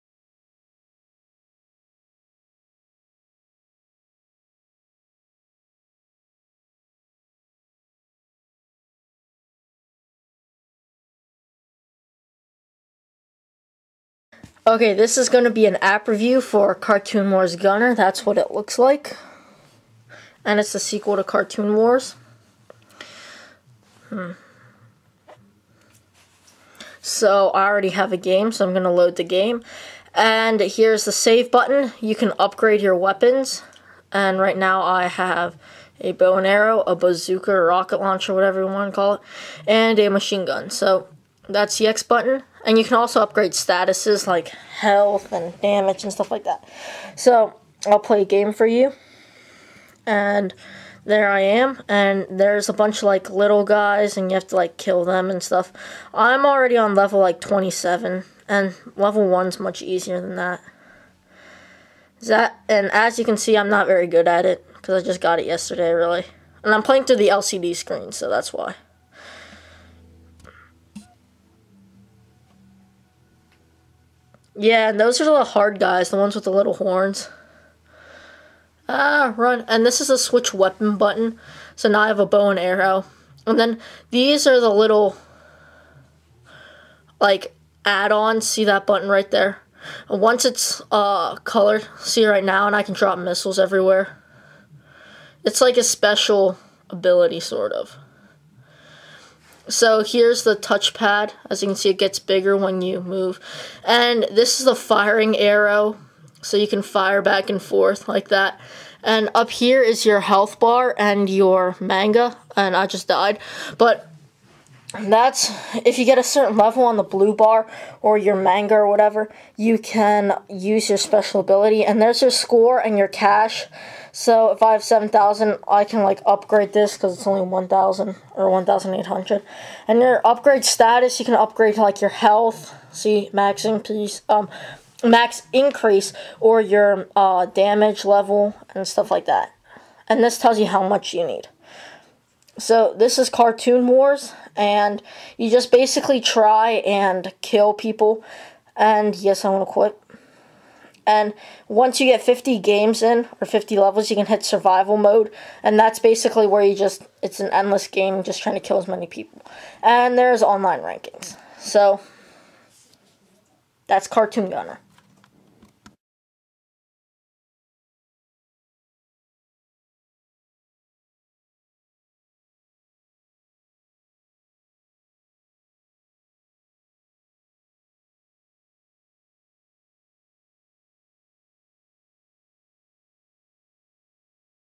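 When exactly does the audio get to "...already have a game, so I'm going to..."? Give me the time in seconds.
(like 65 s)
27 s.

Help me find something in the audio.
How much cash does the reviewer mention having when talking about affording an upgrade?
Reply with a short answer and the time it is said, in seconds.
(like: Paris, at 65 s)
7,000, at 124 s.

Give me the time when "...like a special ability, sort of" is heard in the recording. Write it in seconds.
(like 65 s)
95 s.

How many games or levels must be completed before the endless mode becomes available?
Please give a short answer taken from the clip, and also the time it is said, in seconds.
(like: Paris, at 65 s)
50, at 152 s.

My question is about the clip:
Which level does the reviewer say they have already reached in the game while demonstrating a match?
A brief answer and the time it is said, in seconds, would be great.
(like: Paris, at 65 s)
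27, at 56 s.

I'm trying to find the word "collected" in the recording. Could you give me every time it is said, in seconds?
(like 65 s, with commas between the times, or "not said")
not said.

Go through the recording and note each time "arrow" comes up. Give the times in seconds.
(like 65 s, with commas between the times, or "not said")
36 s, 82 s, 105 s.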